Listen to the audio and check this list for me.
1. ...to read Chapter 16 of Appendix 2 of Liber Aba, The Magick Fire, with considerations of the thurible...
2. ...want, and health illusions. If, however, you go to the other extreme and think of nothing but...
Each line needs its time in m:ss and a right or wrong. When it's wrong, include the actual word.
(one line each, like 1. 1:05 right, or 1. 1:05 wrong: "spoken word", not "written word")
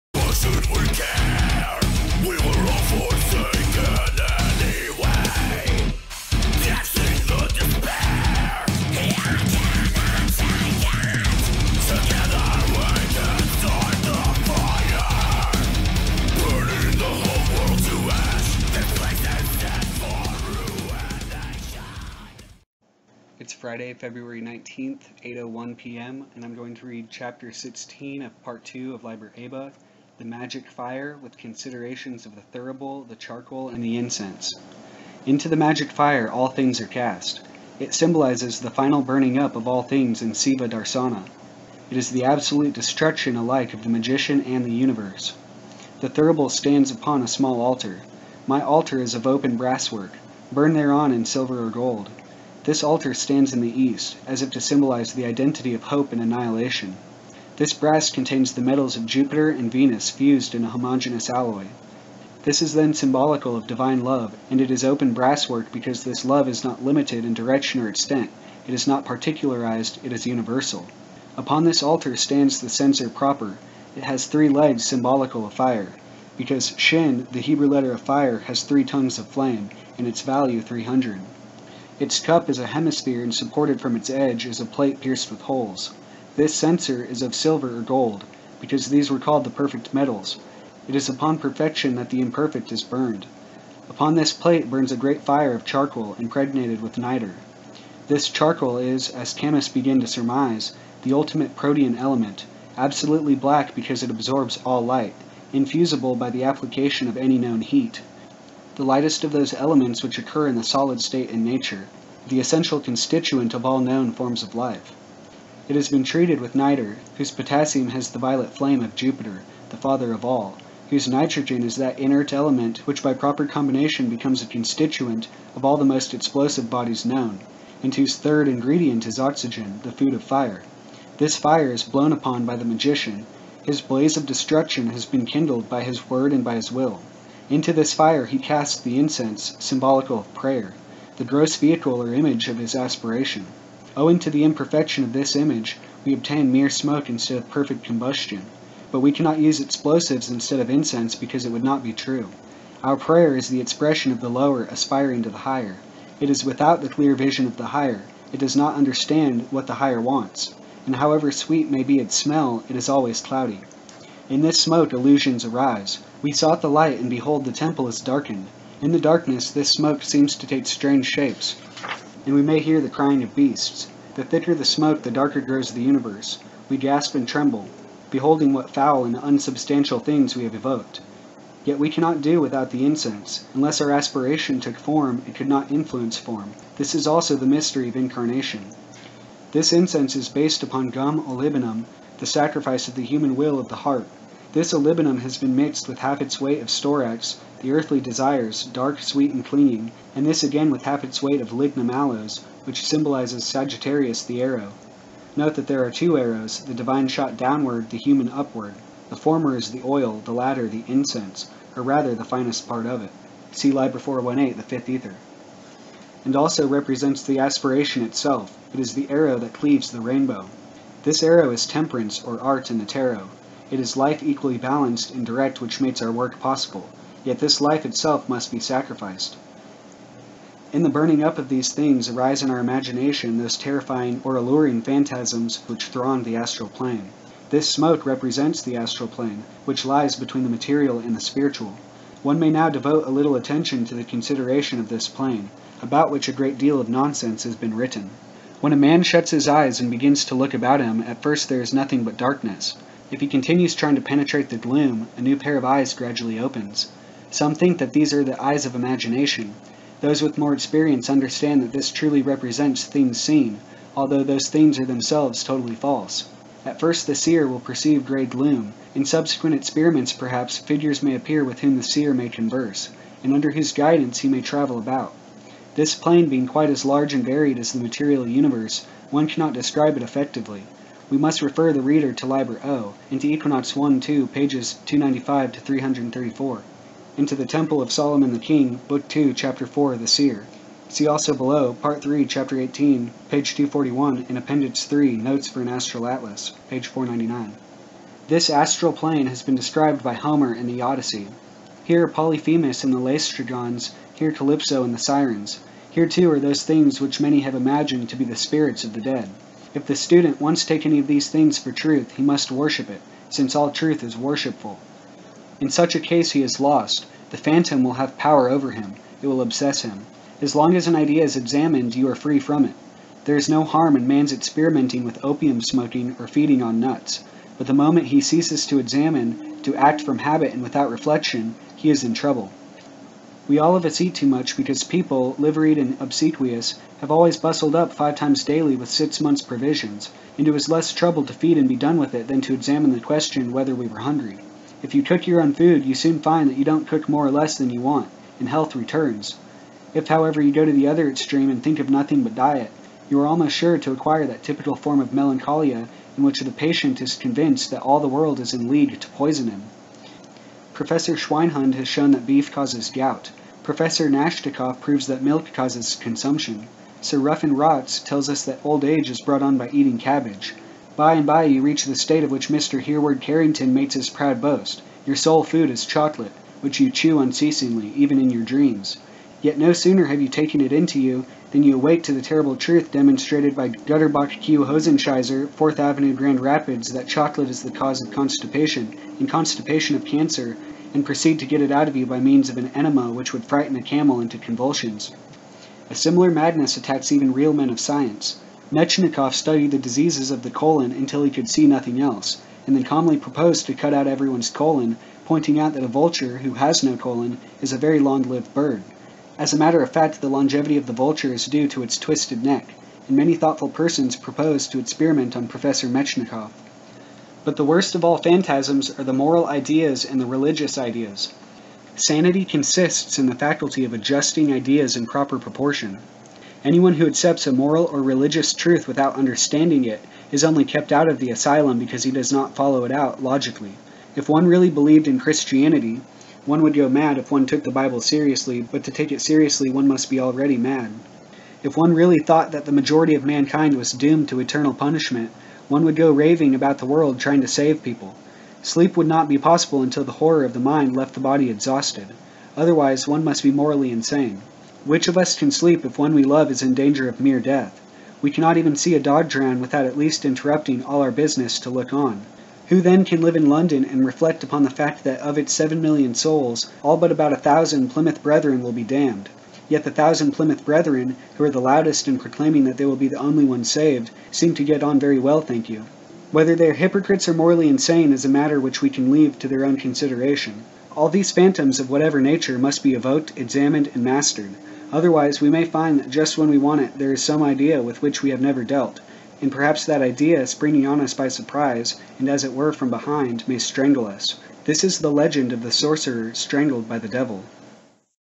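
1. 0:26 wrong: "Part", not "Appendix"
2. 5:47 wrong: "returns", not "illusions".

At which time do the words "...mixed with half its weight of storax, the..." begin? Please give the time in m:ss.
3:15.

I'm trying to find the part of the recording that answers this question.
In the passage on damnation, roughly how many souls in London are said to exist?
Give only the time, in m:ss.
7:45.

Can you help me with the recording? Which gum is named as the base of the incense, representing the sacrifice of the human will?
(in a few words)
Gum olibanum.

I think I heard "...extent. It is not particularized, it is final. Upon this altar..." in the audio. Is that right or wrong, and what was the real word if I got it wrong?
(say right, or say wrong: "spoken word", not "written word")
wrong: "universal", not "final".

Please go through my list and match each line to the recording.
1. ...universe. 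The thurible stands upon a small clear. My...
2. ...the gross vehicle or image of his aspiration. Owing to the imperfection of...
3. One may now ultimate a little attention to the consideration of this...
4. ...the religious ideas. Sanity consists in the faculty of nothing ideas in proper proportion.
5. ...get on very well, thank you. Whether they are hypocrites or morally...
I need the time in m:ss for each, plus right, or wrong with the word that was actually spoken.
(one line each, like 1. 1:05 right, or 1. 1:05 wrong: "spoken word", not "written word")
1. 0:44 wrong: "altar", not "clear"
2. 2:21 right
3. 4:02 wrong: "devote", not "ultimate"
4. 7:00 wrong: "adjusting", not "nothing"
5. 7:54 right.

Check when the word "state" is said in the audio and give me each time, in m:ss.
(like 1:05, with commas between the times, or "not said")
1:51, 6:11.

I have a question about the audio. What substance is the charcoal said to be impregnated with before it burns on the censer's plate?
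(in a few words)
Niter.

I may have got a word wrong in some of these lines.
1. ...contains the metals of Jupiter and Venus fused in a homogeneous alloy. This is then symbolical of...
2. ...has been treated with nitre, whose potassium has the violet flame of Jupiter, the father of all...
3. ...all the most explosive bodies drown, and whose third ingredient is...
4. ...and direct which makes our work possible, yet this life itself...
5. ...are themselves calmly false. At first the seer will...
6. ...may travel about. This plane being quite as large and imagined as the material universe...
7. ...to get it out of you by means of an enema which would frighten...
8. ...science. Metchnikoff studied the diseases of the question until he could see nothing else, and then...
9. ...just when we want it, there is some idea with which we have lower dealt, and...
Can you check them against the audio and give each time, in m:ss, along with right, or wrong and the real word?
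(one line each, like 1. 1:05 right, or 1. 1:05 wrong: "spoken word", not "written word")
1. 0:58 right
2. 1:55 right
3. 2:05 wrong: "known", not "drown"
4. 3:45 right
5. 4:24 wrong: "totally", not "calmly"
6. 4:34 wrong: "varied", not "imagined"
7. 6:31 right
8. 6:37 wrong: "colon", not "question"
9. 8:06 wrong: "never", not "lower".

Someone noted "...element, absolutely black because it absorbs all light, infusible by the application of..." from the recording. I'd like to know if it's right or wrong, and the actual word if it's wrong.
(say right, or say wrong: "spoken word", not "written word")
right.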